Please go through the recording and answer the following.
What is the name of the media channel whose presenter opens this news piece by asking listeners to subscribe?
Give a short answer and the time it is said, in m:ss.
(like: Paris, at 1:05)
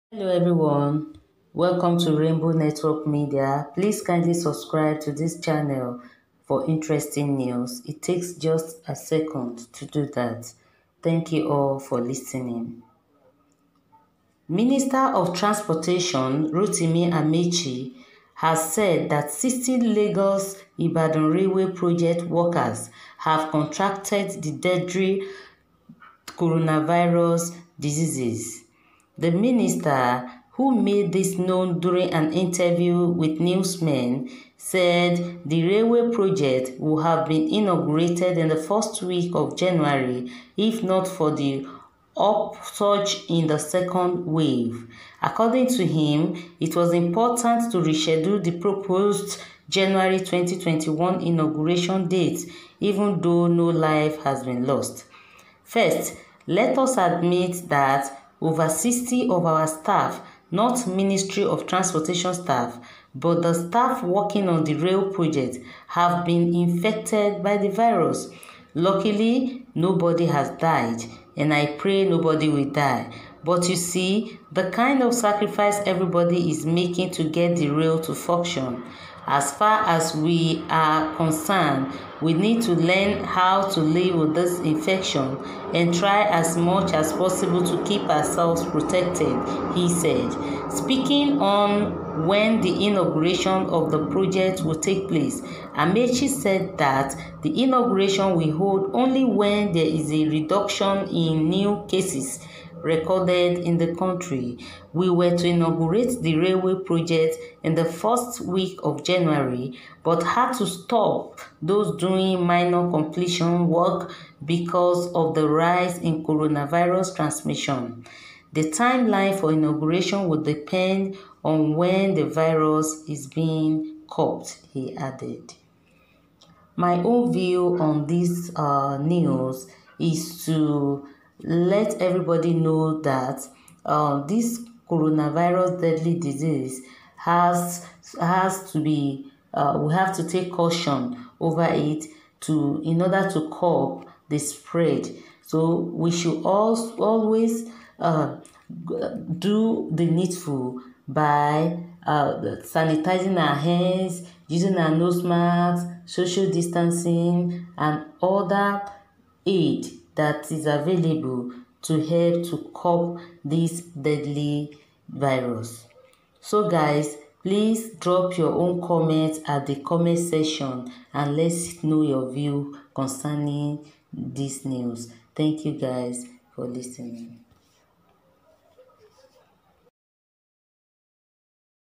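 Rainbow Network Media, at 0:02.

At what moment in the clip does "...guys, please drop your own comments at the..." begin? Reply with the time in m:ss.
2:46.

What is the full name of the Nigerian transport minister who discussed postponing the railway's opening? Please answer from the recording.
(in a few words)
Rotimi Amaechi.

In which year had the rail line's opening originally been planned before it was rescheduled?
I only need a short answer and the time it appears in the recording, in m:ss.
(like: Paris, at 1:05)
2021, at 0:50.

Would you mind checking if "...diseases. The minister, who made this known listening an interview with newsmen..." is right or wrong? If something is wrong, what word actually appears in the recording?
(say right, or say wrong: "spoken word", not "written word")
wrong: "during", not "listening".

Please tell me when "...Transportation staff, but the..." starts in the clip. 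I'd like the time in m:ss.
1:01.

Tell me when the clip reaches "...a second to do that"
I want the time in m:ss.
0:08.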